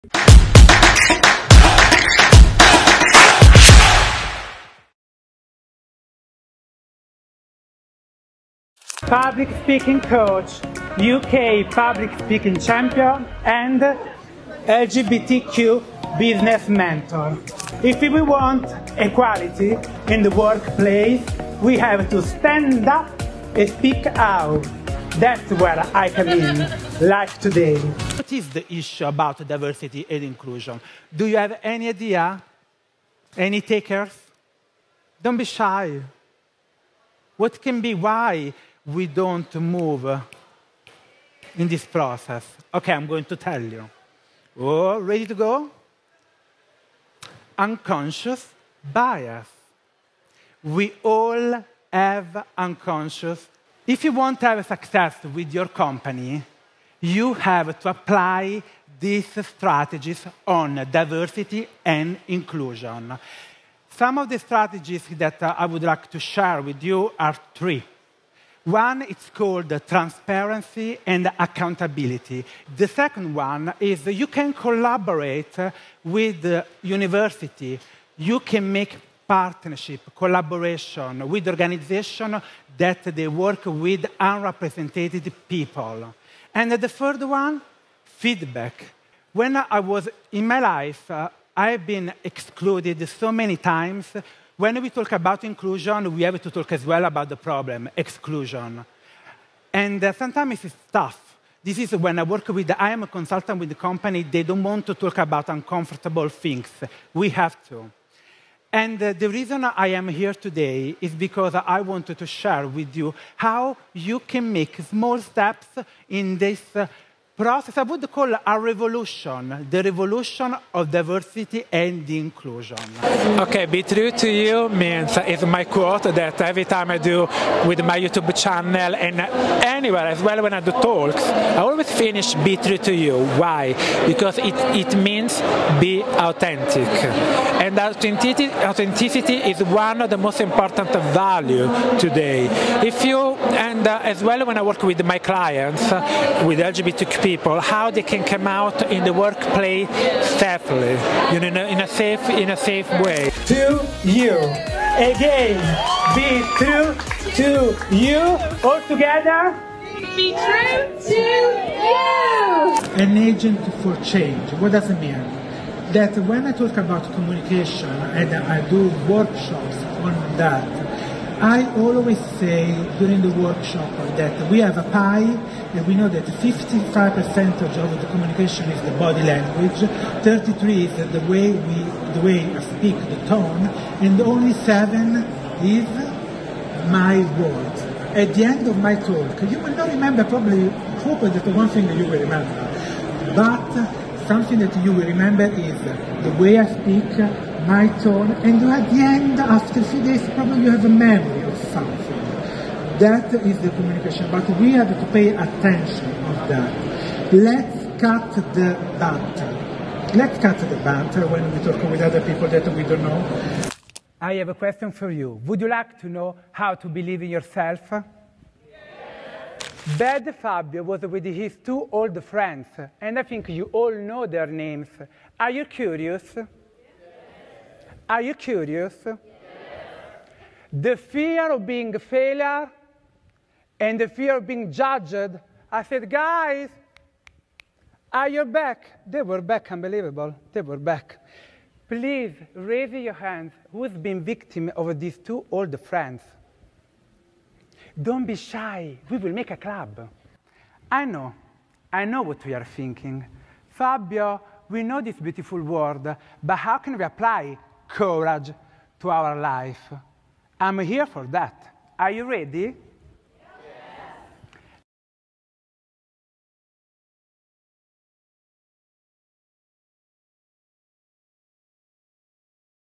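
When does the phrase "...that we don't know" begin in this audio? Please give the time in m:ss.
3:32.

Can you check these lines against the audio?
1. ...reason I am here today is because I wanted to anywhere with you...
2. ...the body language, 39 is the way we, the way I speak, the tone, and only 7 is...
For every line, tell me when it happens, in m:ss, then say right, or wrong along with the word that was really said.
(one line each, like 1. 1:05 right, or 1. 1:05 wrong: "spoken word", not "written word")
1. 1:49 wrong: "share", not "anywhere"
2. 2:58 wrong: "33", not "39".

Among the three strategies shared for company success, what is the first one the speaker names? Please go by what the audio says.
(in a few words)
Transparency and accountability.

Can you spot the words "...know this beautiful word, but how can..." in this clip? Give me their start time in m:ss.
4:14.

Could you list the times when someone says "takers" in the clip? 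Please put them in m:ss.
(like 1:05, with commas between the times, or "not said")
0:33.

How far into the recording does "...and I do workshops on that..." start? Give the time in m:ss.
2:48.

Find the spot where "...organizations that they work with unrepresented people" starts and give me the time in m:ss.
1:21.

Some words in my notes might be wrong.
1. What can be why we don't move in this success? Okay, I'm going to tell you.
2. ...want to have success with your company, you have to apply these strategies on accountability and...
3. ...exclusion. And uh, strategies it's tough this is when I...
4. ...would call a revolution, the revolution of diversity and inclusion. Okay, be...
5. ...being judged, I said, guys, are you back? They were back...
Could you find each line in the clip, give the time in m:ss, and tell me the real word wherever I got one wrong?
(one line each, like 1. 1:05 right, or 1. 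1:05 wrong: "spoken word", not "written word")
1. 0:37 wrong: "process", not "success"
2. 0:54 wrong: "diversity", not "accountability"
3. 1:37 wrong: "sometimes", not "strategies"
4. 1:57 right
5. 3:54 right.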